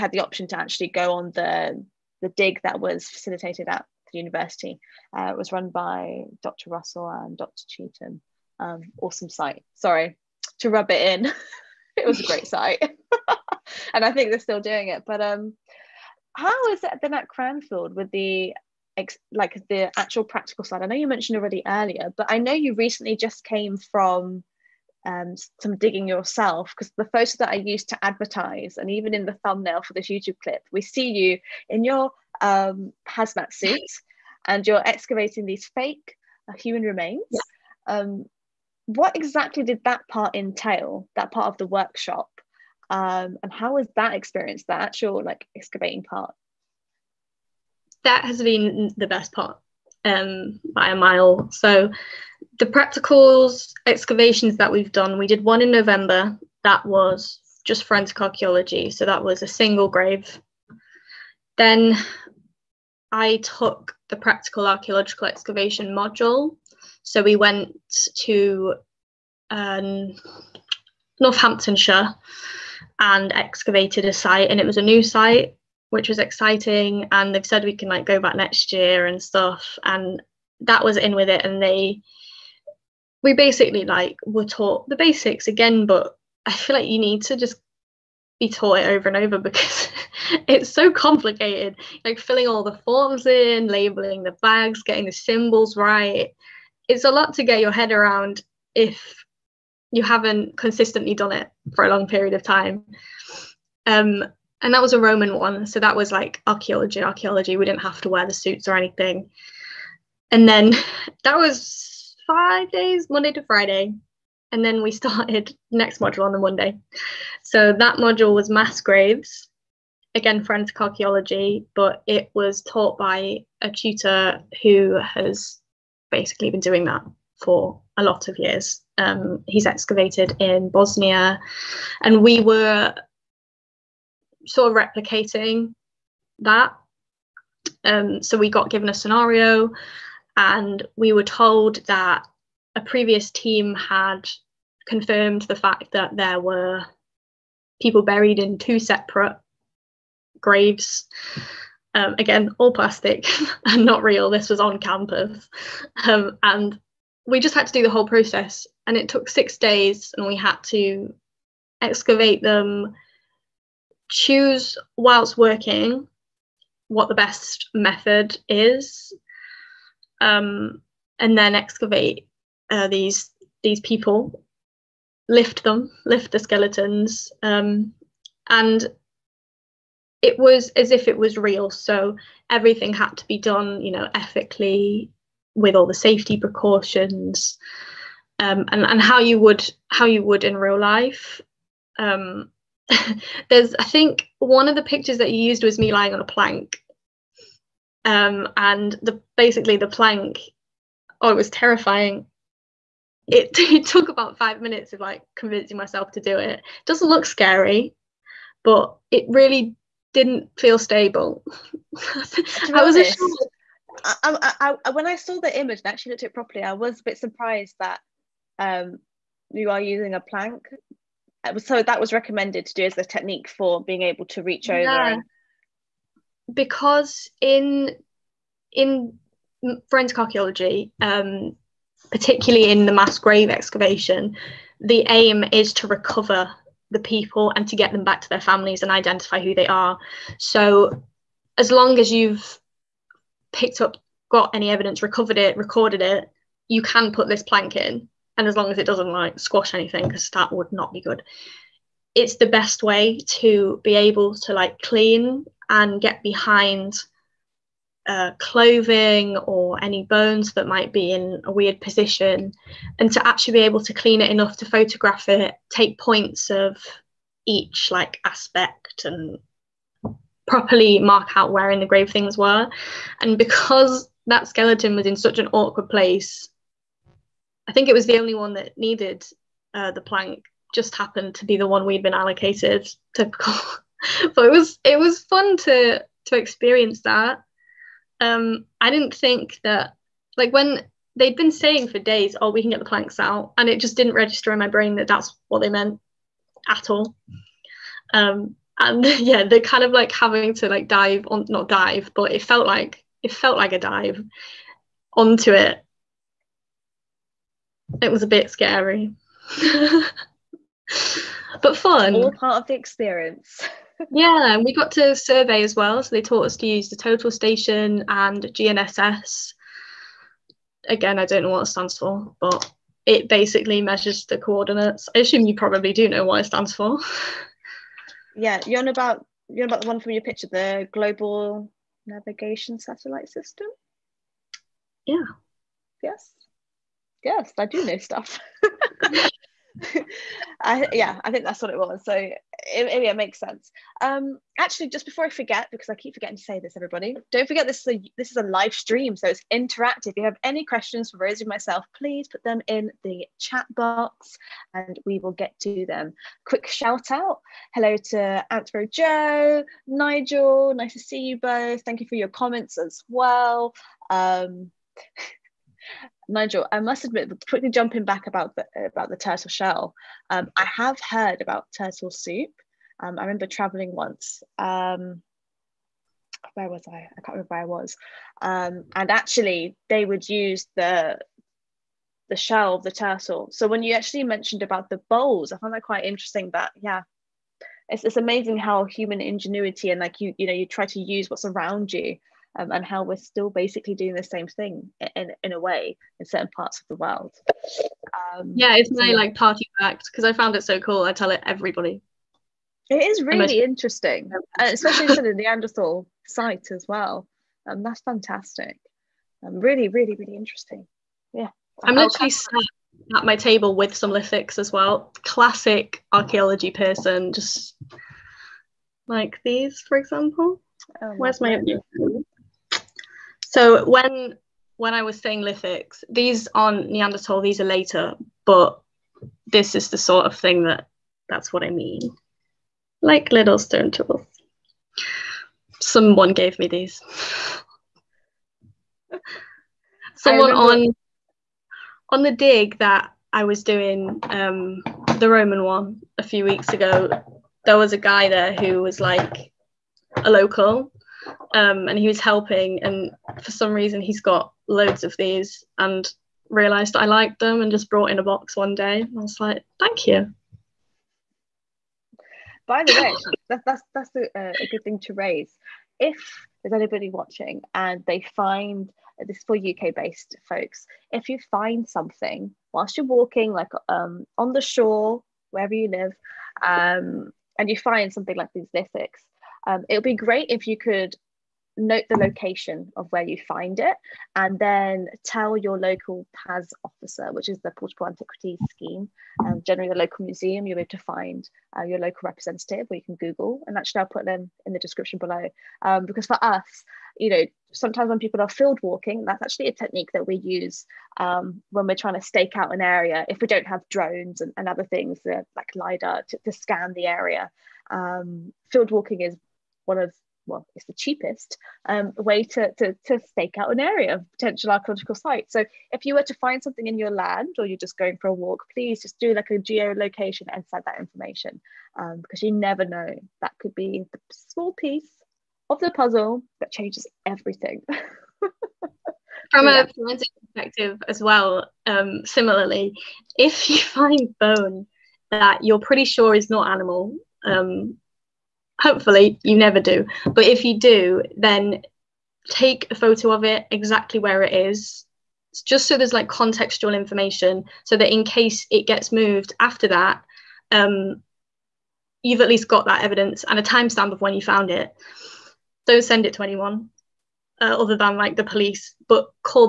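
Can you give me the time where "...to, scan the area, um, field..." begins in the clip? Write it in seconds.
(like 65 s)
506 s.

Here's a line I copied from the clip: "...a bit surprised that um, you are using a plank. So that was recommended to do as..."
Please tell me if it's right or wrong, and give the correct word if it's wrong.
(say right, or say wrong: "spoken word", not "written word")
right.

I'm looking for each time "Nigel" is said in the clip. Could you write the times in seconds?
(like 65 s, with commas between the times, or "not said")
359 s, 366 s.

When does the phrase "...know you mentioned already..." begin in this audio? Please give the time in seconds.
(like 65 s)
20 s.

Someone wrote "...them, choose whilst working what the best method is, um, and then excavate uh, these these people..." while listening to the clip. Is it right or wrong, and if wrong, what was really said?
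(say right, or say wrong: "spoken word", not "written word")
right.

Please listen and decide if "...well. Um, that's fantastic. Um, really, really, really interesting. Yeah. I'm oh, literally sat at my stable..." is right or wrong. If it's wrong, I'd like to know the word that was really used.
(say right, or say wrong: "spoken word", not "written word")
wrong: "table", not "stable".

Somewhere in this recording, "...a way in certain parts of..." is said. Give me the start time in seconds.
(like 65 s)
395 s.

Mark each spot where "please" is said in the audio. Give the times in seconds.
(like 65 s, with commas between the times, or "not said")
351 s, 518 s.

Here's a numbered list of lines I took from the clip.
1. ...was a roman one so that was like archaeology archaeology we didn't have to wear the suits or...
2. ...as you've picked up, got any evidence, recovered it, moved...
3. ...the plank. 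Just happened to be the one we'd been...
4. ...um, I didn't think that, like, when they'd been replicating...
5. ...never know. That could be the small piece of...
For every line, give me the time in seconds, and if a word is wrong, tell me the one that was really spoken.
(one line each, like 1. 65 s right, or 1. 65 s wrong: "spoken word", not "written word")
1. 104 s right
2. 241 s wrong: "recorded", not "moved"
3. 279 s right
4. 288 s wrong: "saying", not "replicating"
5. 522 s right.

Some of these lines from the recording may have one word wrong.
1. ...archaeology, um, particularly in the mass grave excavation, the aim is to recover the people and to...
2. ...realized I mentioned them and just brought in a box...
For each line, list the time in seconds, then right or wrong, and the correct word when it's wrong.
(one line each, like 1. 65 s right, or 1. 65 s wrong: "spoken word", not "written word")
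1. 230 s right
2. 456 s wrong: "liked", not "mentioned".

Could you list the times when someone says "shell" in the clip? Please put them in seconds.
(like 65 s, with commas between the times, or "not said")
369 s, 382 s.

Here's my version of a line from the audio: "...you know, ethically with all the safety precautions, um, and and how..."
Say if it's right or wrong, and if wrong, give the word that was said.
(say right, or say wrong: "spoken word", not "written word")
right.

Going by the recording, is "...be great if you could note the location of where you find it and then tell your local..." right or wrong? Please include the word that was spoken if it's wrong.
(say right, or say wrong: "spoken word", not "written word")
right.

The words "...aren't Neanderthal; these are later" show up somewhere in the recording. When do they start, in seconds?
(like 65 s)
426 s.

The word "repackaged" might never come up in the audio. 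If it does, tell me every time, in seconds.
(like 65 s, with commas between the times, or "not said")
not said.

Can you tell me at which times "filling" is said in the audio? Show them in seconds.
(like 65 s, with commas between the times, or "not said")
92 s.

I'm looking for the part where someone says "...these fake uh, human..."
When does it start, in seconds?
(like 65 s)
35 s.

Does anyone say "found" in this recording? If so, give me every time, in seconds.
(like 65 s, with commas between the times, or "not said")
385 s, 400 s, 554 s.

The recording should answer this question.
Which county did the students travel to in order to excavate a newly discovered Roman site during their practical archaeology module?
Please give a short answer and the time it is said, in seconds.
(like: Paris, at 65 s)
Northamptonshire, at 71 s.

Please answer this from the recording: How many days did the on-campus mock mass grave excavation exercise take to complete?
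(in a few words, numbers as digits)
6.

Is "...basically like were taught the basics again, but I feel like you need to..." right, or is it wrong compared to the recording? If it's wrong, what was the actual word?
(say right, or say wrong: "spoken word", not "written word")
right.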